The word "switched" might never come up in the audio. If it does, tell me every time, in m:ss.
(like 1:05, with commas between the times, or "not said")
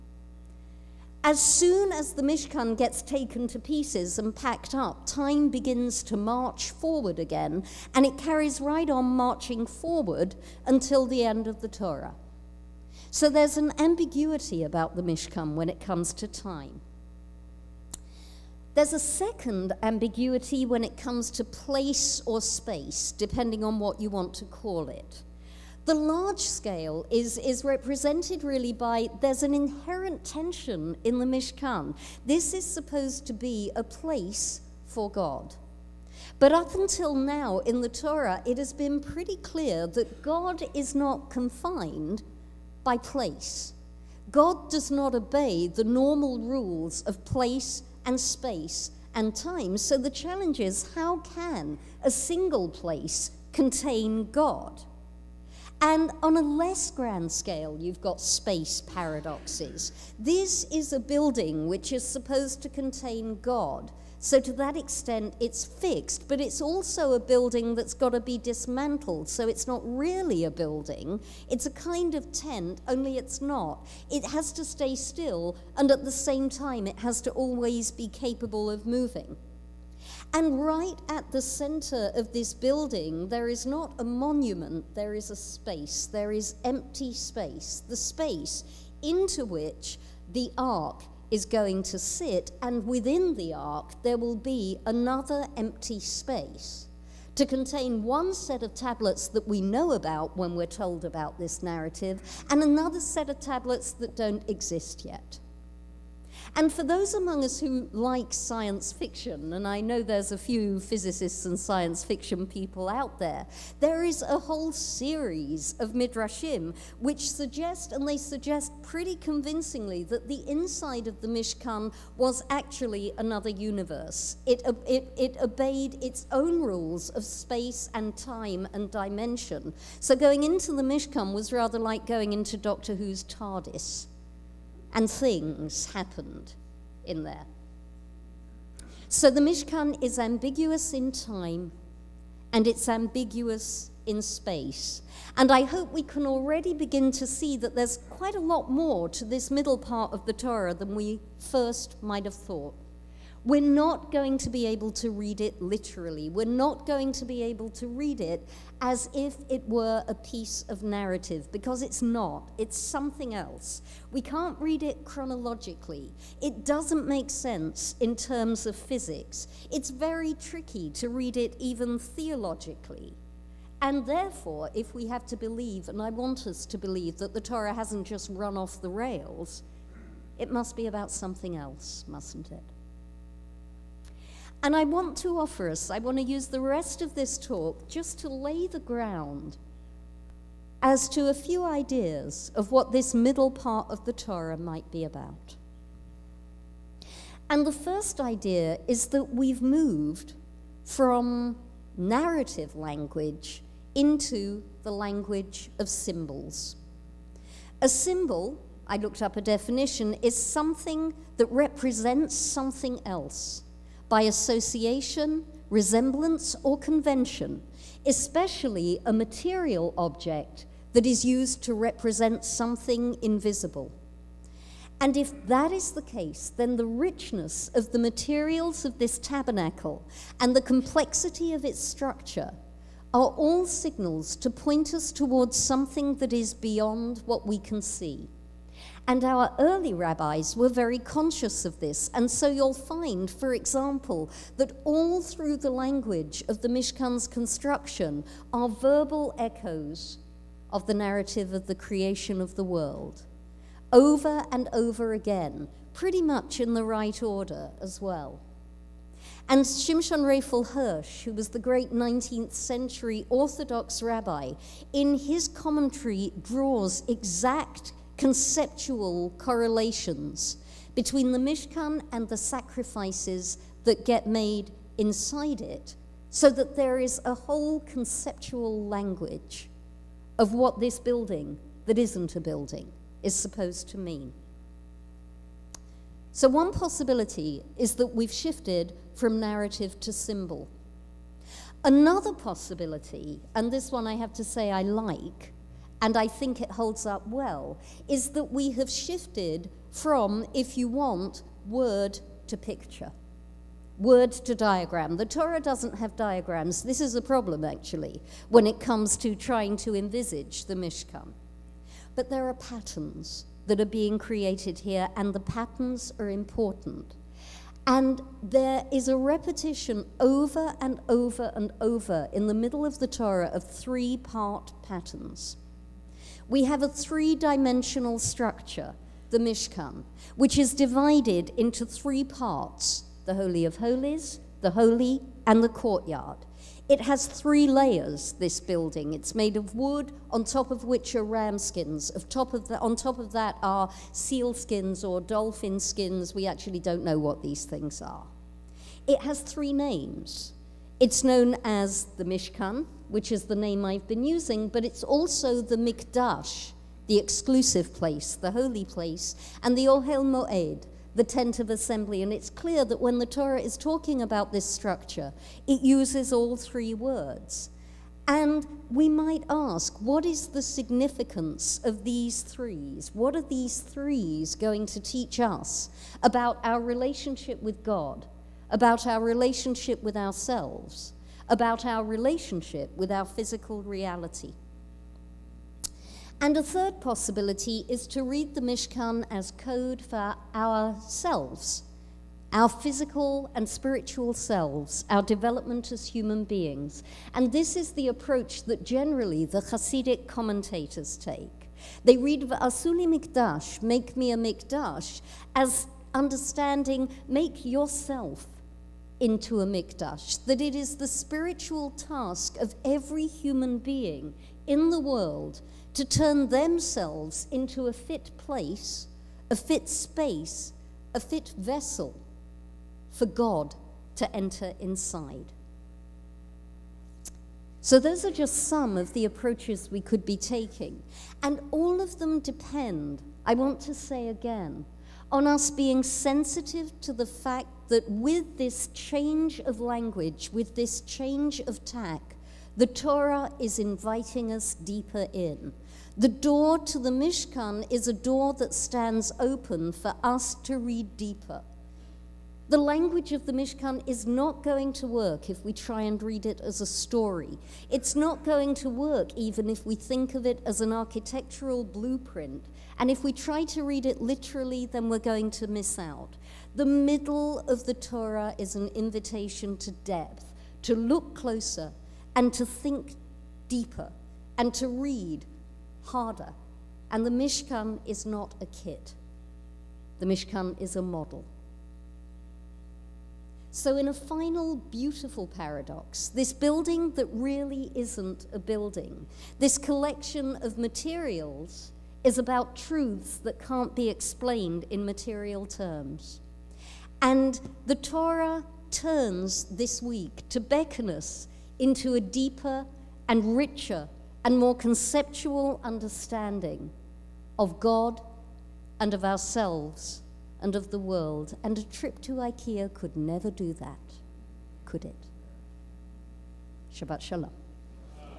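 not said.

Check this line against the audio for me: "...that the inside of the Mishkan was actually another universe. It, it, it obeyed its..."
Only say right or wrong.
right.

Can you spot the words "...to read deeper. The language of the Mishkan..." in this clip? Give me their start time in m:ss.
7:30.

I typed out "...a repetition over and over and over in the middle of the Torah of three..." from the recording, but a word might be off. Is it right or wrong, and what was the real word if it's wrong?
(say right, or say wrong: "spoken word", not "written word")
right.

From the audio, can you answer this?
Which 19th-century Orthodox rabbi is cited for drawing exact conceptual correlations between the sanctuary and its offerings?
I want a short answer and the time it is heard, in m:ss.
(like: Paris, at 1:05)
Shimshon Raphael Hirsch, at 4:19.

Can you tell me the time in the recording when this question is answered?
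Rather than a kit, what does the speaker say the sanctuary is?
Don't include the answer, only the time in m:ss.
8:00.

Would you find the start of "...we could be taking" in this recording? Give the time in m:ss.
7:09.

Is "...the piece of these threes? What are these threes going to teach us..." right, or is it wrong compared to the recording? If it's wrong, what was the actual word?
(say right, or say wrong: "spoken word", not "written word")
wrong: "significance", not "piece".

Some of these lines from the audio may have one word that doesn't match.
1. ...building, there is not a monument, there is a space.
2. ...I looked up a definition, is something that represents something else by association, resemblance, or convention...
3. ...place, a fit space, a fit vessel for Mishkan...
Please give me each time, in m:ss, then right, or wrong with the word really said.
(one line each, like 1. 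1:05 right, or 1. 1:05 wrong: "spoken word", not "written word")
1. 1:22 right
2. 3:28 right
3. 6:58 wrong: "God", not "Mishkan".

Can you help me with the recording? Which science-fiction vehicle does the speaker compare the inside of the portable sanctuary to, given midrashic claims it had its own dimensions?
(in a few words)
Doctor Who's TARDIS.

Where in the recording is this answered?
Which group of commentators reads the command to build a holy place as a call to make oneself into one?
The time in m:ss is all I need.
6:39.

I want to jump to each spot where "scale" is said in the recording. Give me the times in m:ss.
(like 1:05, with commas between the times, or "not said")
0:26, 0:57.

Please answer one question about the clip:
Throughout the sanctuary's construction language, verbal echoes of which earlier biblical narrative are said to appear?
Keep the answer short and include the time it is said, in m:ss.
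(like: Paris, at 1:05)
Creation of the world, at 4:11.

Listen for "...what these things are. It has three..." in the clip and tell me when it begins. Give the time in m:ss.
5:47.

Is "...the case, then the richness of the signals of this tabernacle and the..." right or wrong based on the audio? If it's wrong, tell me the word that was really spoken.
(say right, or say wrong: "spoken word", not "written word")
wrong: "materials", not "signals".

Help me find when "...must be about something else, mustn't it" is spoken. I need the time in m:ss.
3:00.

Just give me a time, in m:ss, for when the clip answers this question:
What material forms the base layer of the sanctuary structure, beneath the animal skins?
5:39.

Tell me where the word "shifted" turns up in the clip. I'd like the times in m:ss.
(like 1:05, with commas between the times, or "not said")
4:48, 4:58.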